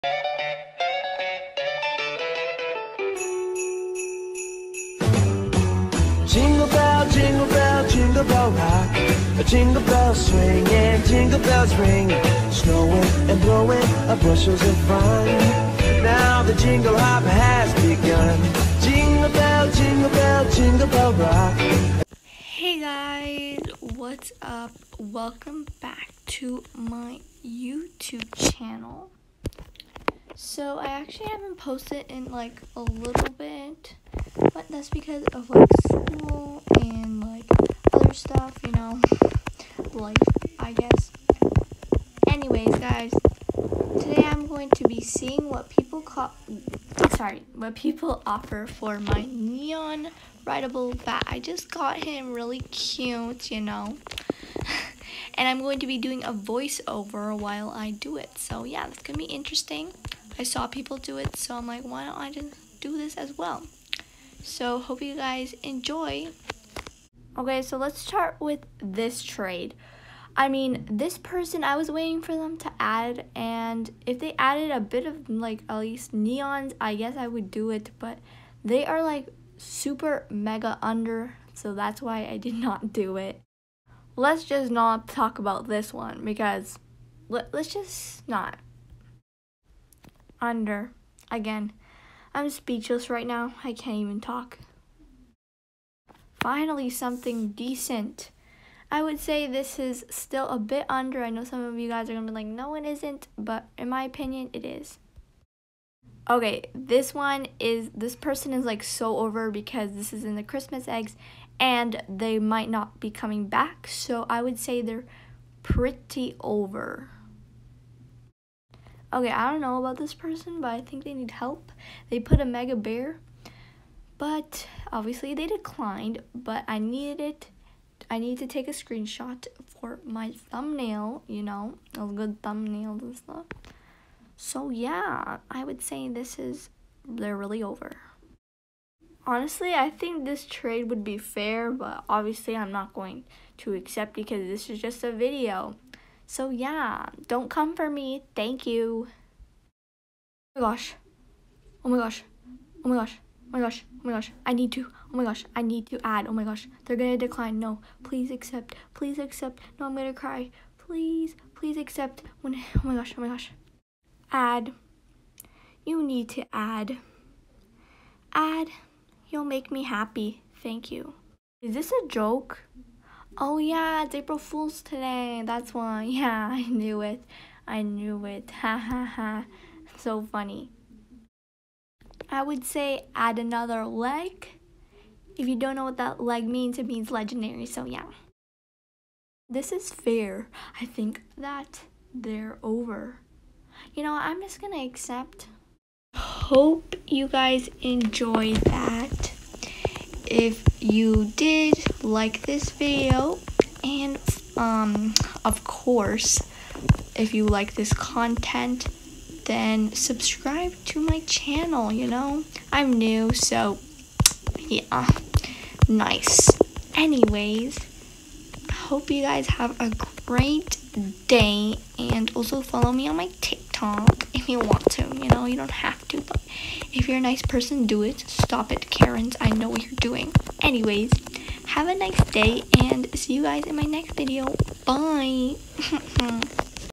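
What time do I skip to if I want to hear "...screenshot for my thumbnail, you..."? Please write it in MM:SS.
02:08.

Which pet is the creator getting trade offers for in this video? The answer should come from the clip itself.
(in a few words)
neon rideable bat.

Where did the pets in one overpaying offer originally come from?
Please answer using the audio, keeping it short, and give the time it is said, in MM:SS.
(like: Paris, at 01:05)
Christmas eggs, at 01:50.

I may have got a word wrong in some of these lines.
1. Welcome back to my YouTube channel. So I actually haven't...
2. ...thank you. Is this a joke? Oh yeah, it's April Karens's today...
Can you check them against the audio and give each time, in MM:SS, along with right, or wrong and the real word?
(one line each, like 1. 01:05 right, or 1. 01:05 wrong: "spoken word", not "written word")
1. 00:24 right
2. 02:50 wrong: "Fool", not "Karens".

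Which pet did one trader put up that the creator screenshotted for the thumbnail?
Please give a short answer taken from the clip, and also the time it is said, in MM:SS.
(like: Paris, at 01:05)
mega bear, at 02:02.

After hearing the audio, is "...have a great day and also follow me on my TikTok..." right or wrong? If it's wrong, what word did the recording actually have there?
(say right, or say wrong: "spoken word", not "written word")
right.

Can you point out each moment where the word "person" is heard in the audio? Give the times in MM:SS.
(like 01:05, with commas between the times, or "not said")
01:11, 01:48, 02:00, 03:47.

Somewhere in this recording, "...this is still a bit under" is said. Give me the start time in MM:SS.
01:39.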